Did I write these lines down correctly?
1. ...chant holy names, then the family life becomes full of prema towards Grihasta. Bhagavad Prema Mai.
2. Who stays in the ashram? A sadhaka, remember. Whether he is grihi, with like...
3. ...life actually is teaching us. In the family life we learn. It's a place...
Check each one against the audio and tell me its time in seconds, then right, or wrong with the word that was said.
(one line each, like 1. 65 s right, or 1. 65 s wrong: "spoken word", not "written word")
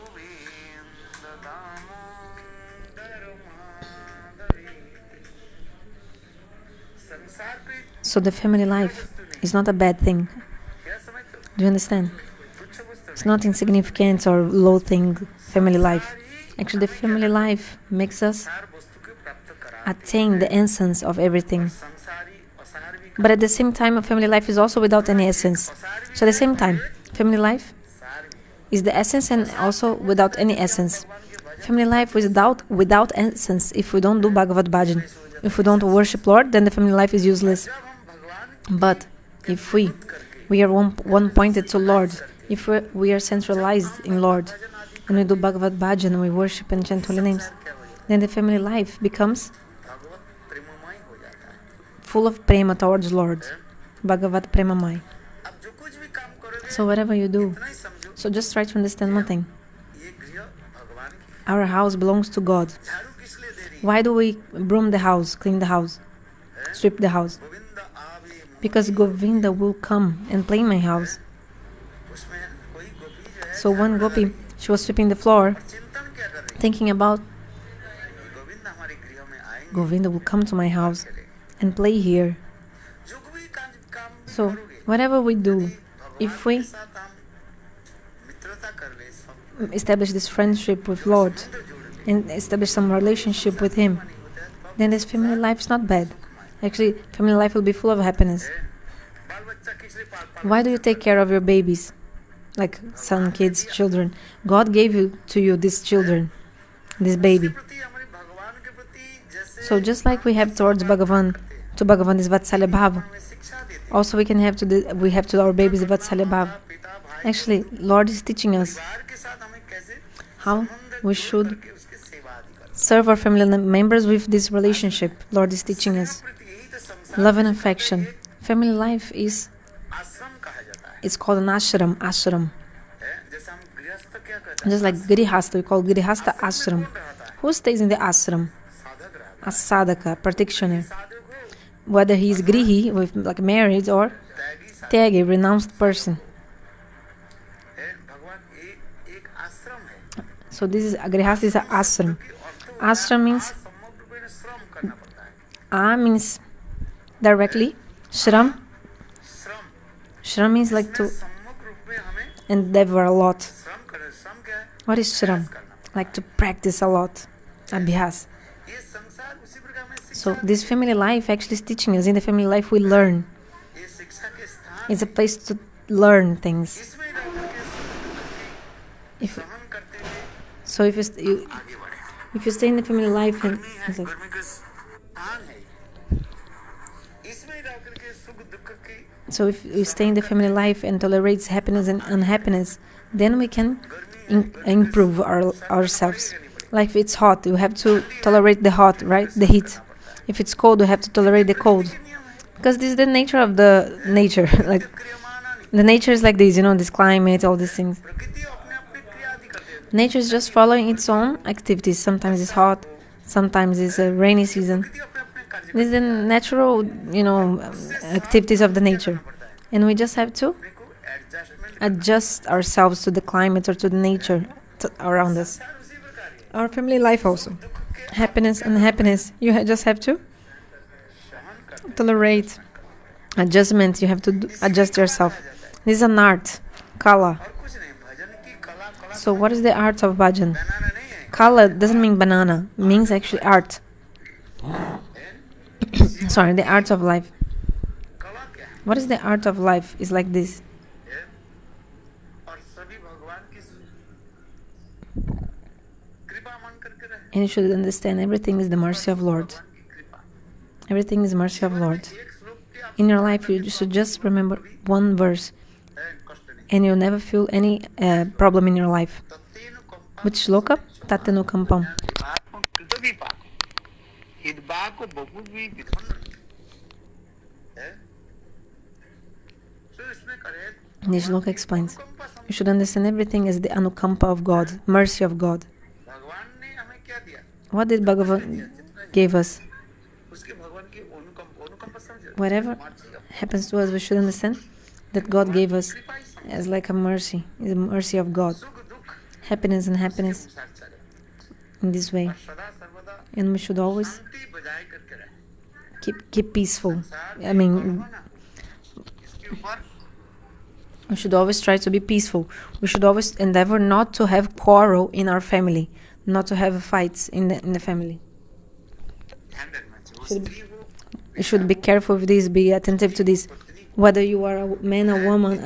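1. 46 s wrong: "Lord", not "Grihasta"
2. 137 s wrong: "practitioner", not "remember"
3. 170 s right.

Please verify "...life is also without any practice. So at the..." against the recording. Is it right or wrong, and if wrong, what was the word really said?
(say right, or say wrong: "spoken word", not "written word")
wrong: "essence", not "practice".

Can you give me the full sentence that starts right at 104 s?
God gave you to you these children, this baby.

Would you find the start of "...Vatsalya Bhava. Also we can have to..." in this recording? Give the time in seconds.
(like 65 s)
112 s.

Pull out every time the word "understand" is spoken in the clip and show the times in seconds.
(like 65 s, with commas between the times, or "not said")
11 s, 58 s, 257 s, 282 s, 294 s.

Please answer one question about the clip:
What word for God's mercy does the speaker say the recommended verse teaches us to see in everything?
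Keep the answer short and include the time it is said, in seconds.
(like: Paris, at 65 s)
anukampa, at 283 s.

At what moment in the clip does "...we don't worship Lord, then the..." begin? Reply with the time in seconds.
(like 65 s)
35 s.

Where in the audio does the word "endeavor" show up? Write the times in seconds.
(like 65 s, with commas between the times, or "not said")
162 s, 313 s.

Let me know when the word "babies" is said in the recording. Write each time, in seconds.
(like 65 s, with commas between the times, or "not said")
101 s, 115 s.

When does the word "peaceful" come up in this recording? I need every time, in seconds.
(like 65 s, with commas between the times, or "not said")
306 s, 312 s.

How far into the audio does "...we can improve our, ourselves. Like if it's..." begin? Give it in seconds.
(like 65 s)
193 s.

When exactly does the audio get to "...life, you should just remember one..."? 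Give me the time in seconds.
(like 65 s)
263 s.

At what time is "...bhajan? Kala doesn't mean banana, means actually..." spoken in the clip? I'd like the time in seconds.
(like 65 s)
240 s.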